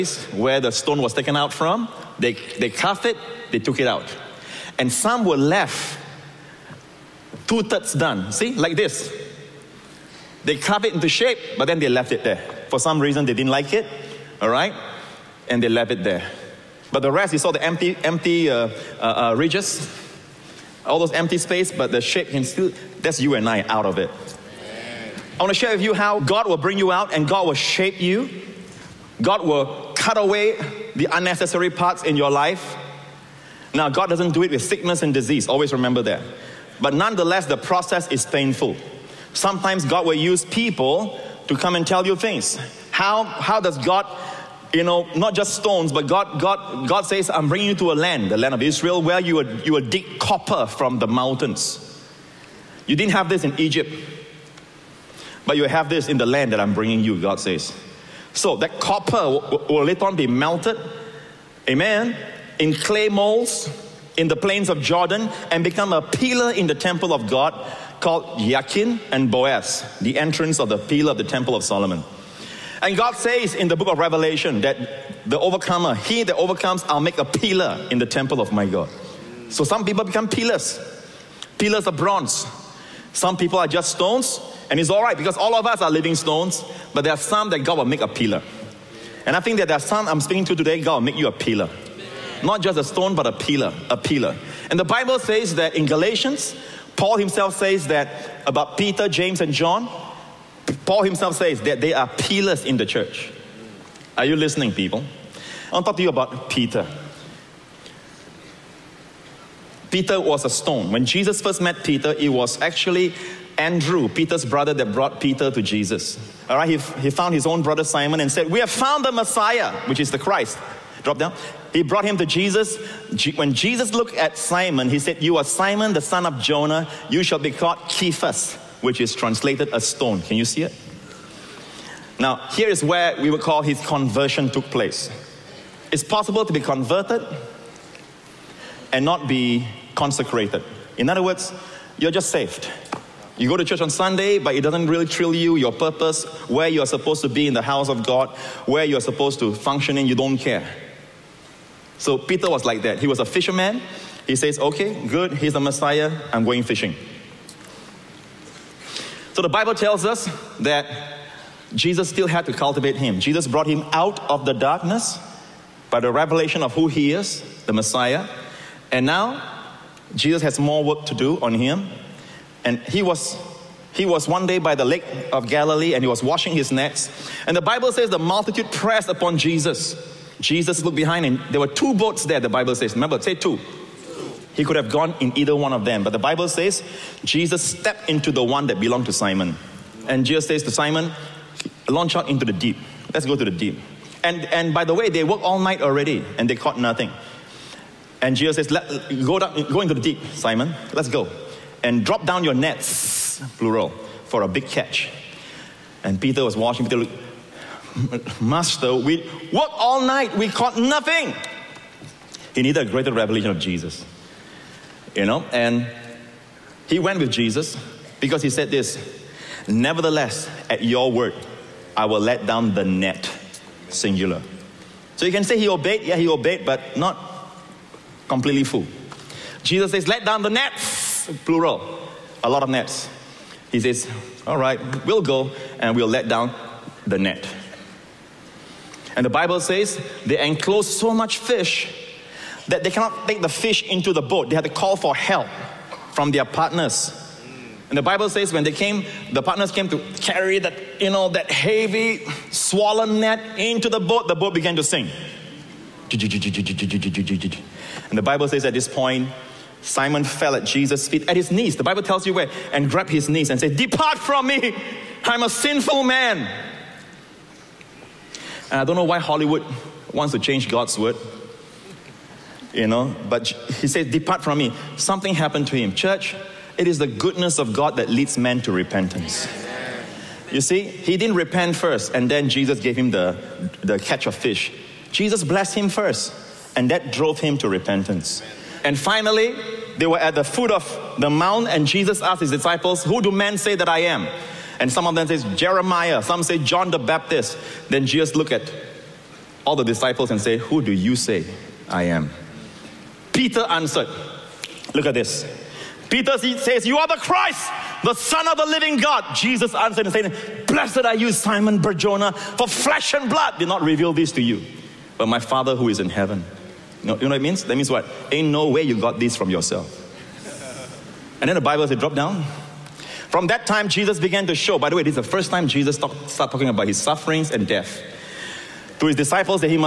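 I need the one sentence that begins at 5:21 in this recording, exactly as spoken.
And then the Bible says, drop down.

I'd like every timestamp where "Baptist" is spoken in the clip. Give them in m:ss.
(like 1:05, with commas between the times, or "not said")
4:56.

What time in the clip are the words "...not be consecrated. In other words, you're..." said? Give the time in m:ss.
2:19.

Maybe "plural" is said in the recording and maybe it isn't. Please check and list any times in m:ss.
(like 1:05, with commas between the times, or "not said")
3:23, 3:51.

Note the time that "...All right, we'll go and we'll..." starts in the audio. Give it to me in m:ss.
3:54.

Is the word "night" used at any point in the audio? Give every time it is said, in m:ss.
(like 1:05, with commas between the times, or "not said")
3:15, 3:30.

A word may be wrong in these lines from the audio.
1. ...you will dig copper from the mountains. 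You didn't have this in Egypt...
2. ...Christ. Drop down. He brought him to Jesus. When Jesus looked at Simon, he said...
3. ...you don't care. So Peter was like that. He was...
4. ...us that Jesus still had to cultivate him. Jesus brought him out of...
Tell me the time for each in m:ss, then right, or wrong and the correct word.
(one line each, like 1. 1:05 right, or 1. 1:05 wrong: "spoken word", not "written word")
1. 0:49 right
2. 2:00 right
3. 2:30 right
4. 2:40 right.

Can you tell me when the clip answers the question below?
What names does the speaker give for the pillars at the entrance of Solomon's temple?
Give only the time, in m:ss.
1:08.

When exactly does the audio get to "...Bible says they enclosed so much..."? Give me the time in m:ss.
3:59.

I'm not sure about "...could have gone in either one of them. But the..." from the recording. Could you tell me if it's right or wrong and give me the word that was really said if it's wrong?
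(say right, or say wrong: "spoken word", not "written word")
right.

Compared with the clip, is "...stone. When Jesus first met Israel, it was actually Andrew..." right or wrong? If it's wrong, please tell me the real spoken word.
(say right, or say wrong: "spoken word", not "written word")
wrong: "Peter", not "Israel".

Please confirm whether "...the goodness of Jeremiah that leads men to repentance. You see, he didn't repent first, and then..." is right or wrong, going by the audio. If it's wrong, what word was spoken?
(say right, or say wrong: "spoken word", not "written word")
wrong: "God", not "Jeremiah".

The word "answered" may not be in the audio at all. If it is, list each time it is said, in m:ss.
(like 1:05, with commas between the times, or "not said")
5:03, 5:09.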